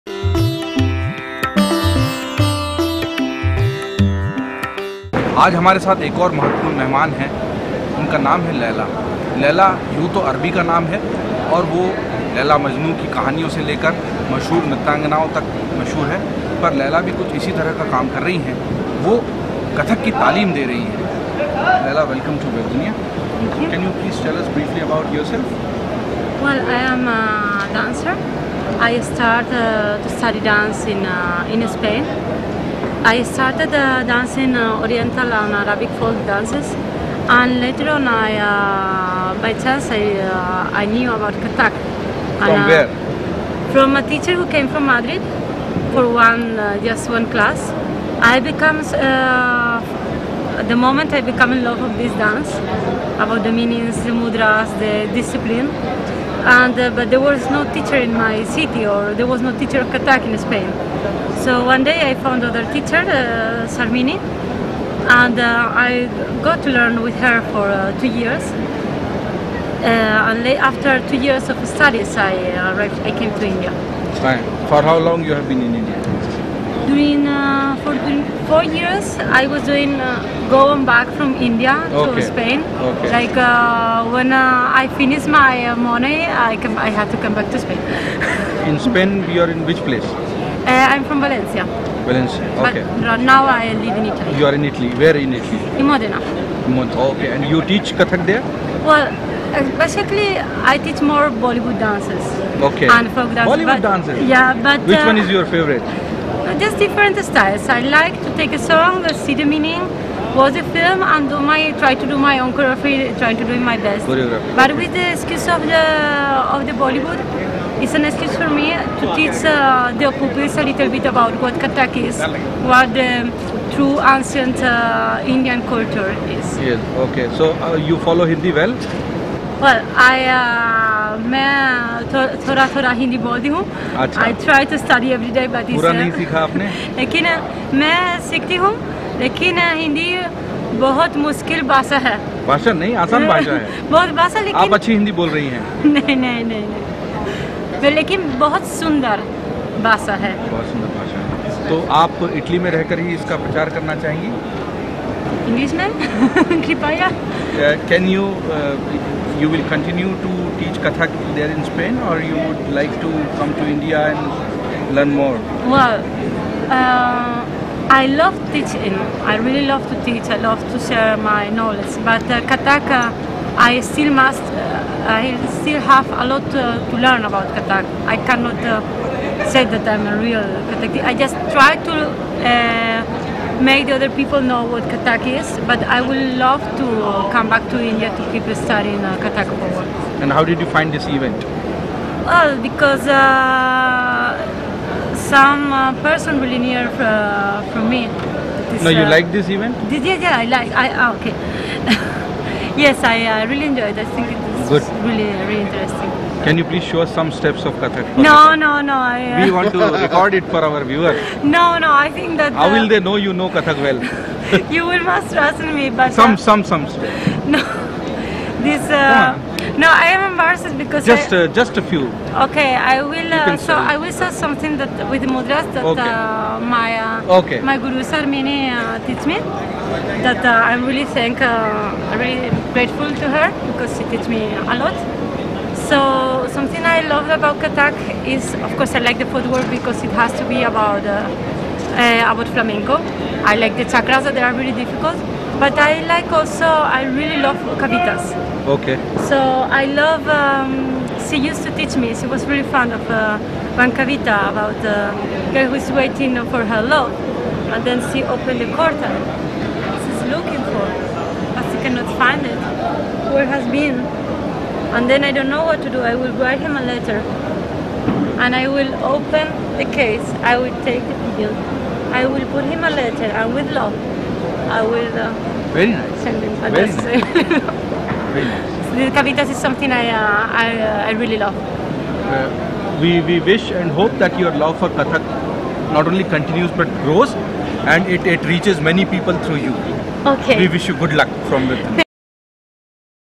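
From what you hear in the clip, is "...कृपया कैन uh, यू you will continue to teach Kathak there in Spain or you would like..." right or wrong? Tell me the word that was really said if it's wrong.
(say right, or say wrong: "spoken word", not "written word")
right.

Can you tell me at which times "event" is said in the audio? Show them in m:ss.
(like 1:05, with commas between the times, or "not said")
3:11, 3:19.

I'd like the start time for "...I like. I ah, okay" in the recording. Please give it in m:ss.
3:20.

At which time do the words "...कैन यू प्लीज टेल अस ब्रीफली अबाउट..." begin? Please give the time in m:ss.
0:23.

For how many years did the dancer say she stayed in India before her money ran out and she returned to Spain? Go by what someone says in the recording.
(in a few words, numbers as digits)
4.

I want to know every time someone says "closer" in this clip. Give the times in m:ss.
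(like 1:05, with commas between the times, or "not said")
not said.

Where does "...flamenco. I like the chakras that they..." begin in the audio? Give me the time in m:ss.
4:02.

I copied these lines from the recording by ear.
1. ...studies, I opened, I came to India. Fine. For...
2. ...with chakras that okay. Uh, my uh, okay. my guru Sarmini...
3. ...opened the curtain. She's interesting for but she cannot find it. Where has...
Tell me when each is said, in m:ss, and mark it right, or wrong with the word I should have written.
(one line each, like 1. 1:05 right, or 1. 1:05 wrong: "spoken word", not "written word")
1. 1:11 wrong: "arrived", not "opened"
2. 3:45 wrong: "mudras", not "chakras"
3. 4:18 wrong: "looking", not "interesting".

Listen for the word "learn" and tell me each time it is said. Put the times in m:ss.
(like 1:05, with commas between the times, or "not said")
1:06, 2:44, 2:57.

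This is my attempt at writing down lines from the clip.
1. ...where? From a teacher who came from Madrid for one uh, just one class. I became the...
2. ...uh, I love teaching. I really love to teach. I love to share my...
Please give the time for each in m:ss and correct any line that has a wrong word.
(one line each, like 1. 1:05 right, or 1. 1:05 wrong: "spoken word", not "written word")
1. 0:42 right
2. 2:46 right.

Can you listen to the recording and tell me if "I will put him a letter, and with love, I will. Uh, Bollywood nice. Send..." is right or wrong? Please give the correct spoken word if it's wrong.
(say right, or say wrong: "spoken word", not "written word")
wrong: "Very", not "Bollywood".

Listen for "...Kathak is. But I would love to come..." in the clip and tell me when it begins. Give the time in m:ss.
3:04.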